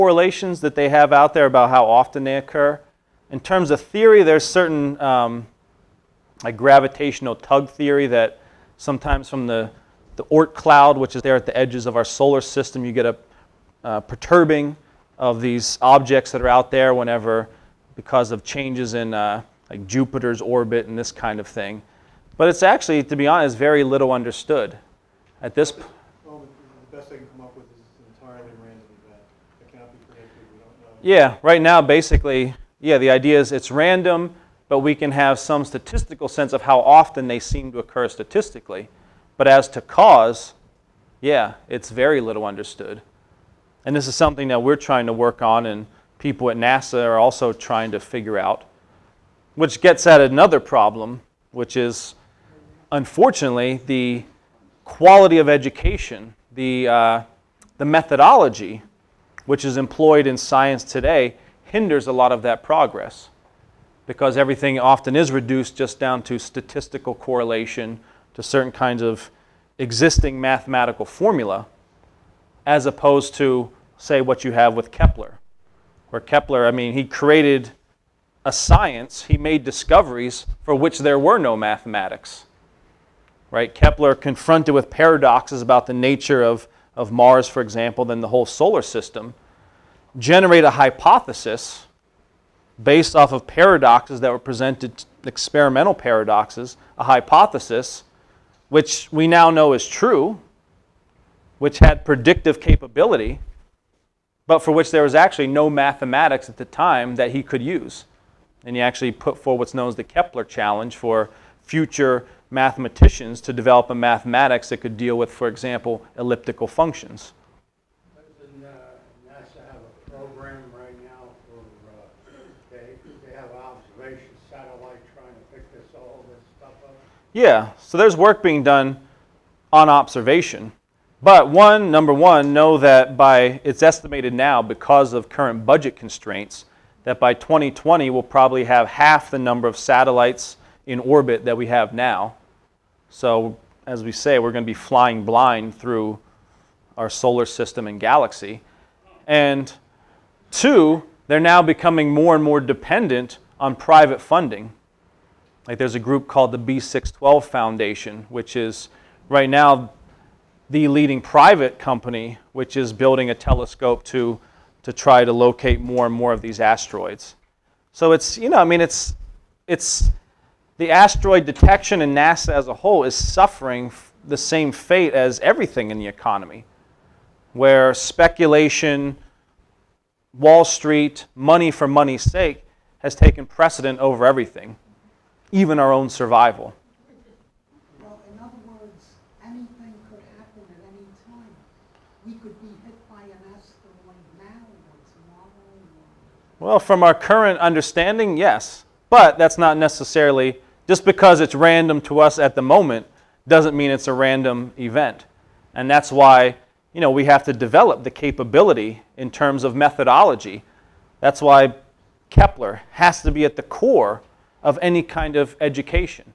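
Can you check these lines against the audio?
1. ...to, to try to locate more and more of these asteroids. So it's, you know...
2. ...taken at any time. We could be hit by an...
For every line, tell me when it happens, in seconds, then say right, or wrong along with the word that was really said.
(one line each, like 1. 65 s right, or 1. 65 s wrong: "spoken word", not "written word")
1. 164 s right
2. 190 s wrong: "happen", not "taken".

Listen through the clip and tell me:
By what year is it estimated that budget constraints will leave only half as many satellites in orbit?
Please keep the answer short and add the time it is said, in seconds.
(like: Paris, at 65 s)
2020, at 137 s.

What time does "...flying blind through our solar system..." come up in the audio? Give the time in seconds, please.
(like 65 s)
144 s.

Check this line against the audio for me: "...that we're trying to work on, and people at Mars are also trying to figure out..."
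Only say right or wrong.
wrong.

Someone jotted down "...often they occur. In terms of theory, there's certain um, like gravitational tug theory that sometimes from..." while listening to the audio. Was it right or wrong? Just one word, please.
right.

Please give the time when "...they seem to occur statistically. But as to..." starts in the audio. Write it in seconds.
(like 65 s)
37 s.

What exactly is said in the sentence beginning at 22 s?
But it's actually, to be honest, very little understood at this point.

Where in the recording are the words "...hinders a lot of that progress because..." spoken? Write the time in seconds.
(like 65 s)
61 s.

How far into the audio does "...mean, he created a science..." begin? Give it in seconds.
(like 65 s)
76 s.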